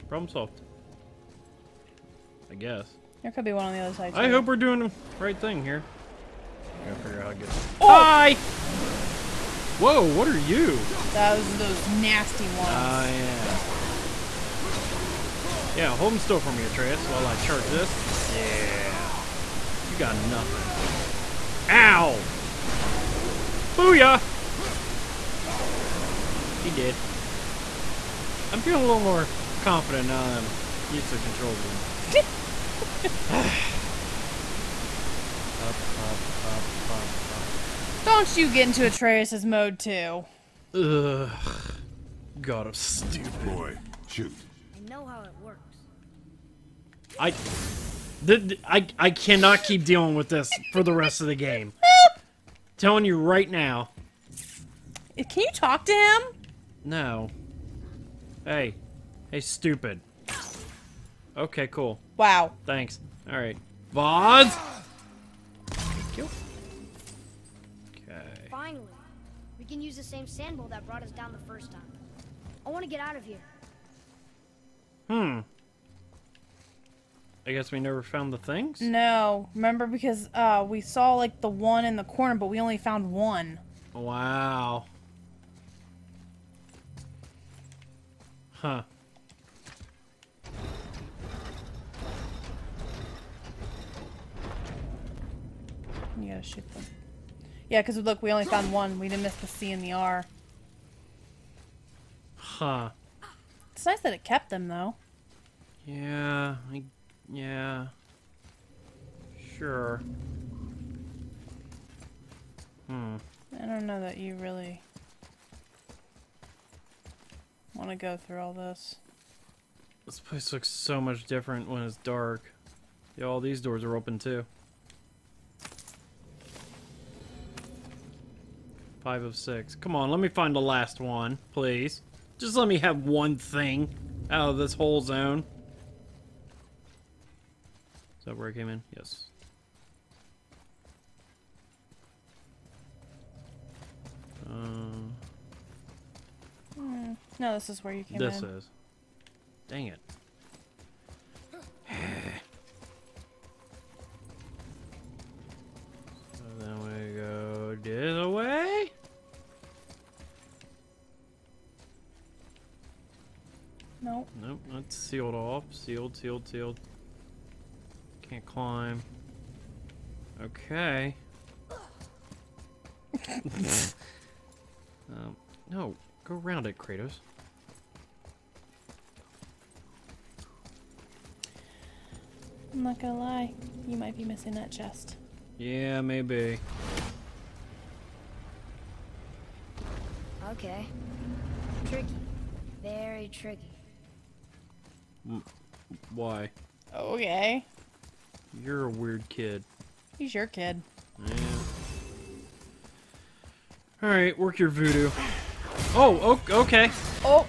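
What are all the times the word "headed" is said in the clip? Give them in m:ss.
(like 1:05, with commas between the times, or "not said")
not said.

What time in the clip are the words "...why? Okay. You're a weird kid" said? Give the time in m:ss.
3:16.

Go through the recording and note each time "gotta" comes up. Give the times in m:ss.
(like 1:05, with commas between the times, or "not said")
0:06, 1:36.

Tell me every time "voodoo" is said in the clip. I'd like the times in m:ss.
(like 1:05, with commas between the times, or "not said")
3:24.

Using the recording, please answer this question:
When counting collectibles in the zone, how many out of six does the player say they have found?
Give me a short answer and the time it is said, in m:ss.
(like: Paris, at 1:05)
5, at 2:09.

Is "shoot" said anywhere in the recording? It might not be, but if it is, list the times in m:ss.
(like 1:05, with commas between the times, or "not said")
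0:44, 1:36.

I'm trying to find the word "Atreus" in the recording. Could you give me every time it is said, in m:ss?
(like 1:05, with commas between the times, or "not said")
0:16, 0:38.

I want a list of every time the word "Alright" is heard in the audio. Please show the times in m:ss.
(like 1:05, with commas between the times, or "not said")
1:03, 3:24.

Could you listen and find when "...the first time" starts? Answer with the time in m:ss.
1:11.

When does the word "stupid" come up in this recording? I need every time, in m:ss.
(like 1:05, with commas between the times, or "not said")
0:42, 0:59.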